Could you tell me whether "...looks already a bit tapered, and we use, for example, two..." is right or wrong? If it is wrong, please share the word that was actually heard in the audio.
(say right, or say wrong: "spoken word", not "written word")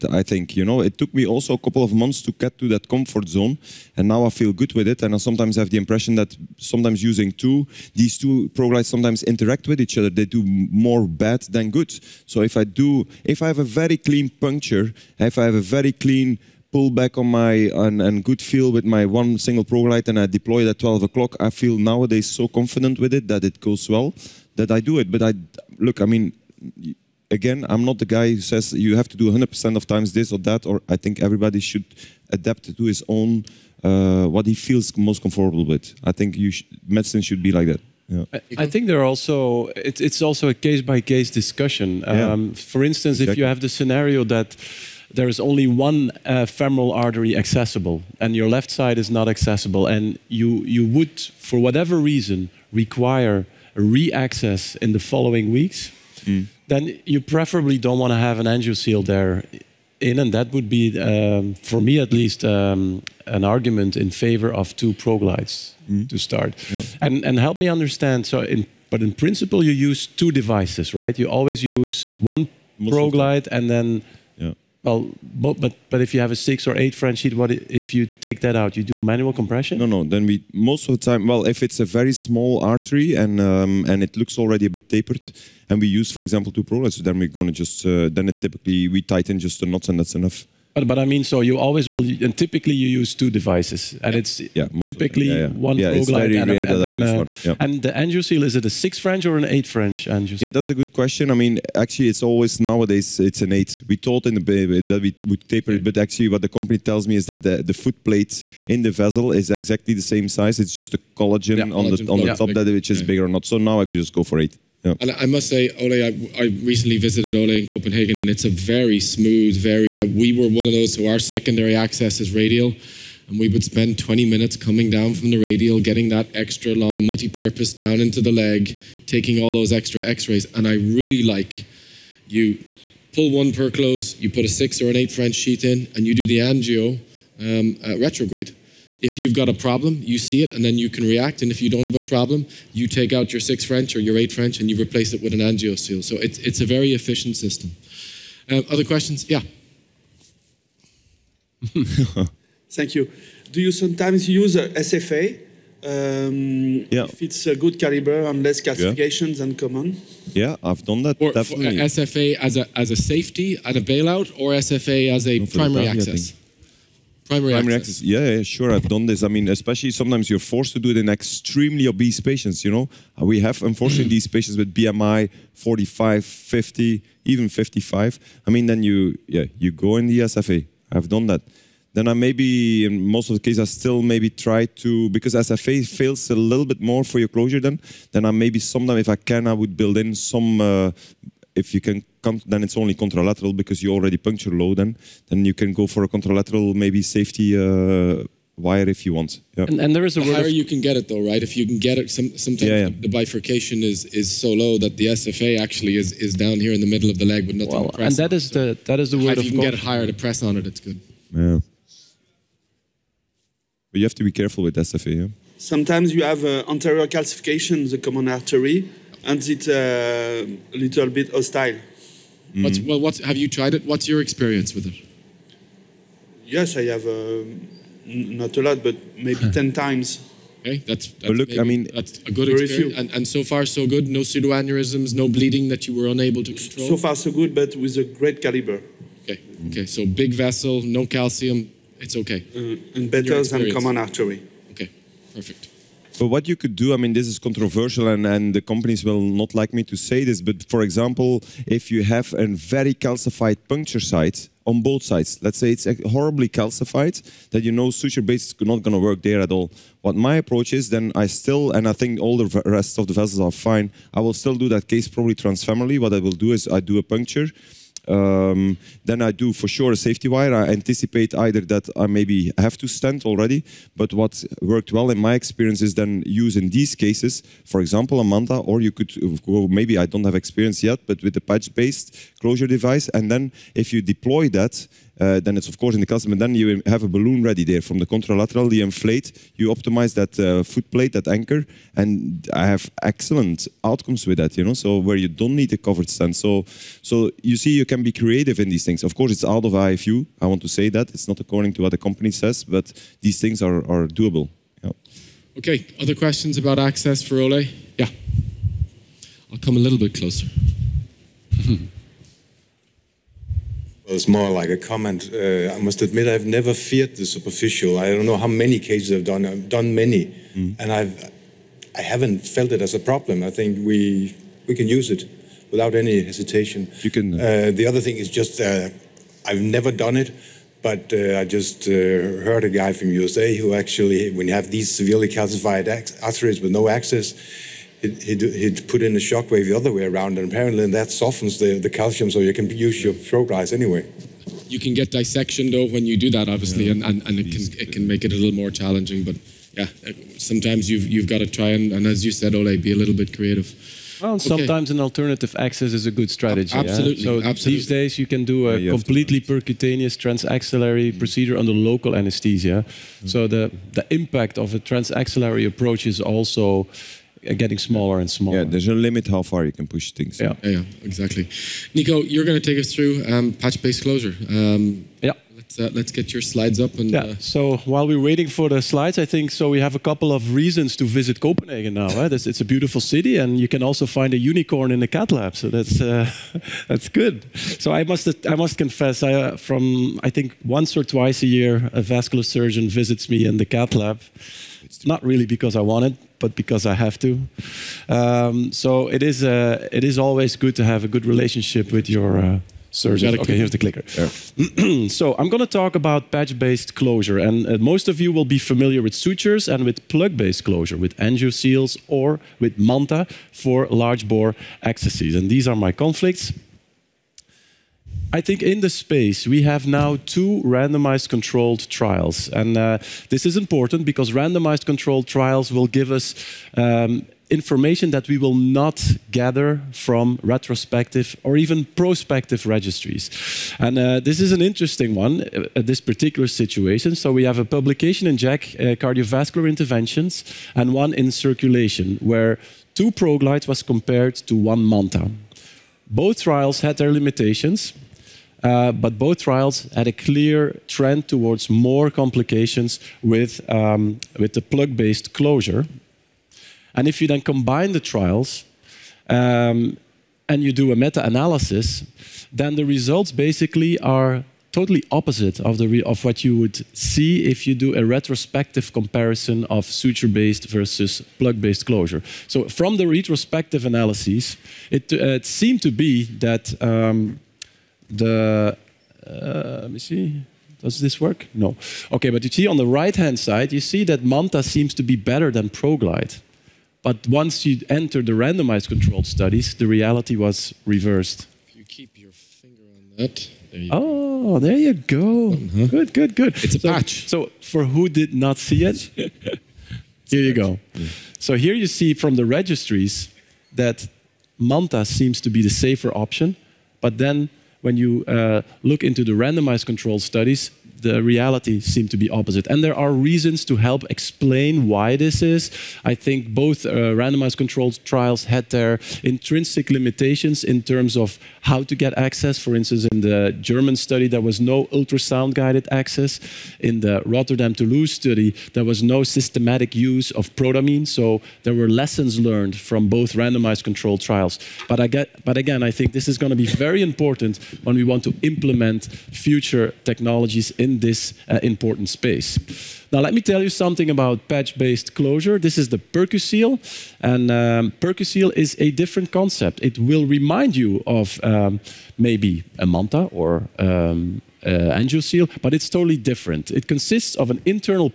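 right.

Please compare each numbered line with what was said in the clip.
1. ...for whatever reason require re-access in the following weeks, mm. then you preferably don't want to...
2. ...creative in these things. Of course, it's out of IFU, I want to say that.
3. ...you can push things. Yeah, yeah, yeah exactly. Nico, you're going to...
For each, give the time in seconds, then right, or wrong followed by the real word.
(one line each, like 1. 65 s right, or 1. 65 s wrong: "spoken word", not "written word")
1. 51 s right
2. 298 s right
3. 369 s right.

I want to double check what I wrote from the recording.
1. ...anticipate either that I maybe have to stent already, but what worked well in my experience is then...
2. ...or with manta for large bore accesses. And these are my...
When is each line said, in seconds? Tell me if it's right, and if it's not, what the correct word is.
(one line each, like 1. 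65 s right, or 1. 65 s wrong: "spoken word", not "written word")
1. 270 s right
2. 412 s right.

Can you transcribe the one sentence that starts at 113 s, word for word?
So now I could just go for eight.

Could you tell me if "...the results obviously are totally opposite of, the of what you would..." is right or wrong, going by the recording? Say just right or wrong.
wrong.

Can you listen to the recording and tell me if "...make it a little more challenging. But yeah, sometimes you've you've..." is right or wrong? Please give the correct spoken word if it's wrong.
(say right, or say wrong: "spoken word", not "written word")
right.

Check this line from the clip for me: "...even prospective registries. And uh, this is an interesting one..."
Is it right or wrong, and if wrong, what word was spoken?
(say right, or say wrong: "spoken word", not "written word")
right.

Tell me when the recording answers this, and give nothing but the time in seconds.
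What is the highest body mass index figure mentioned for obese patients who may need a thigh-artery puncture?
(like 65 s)
177 s.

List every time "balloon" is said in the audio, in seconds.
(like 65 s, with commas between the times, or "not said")
287 s.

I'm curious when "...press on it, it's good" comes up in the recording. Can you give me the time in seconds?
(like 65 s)
210 s.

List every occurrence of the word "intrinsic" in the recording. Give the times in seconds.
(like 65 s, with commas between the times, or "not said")
519 s.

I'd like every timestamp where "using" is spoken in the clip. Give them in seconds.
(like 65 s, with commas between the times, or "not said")
7 s.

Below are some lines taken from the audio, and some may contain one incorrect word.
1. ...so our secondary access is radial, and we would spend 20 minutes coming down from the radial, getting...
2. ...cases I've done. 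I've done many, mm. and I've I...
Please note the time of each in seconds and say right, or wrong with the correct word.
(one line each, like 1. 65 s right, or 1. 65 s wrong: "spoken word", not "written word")
1. 120 s right
2. 318 s right.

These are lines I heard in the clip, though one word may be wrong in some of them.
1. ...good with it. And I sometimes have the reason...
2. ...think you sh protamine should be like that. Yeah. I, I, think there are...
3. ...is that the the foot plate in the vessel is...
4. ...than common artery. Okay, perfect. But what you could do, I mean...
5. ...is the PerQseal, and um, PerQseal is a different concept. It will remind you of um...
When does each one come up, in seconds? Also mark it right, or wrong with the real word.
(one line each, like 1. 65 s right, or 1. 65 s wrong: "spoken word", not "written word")
1. 4 s wrong: "impression", not "reason"
2. 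36 s wrong: "medicine", not "protamine"
3. 107 s right
4. 243 s right
5. 545 s right.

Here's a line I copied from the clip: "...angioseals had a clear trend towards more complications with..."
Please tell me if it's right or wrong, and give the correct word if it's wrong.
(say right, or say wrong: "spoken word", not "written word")
wrong: "trials", not "angioseals".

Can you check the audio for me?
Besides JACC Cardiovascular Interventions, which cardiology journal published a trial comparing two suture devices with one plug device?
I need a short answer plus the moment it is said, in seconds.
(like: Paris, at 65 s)
Circulation, at 441 s.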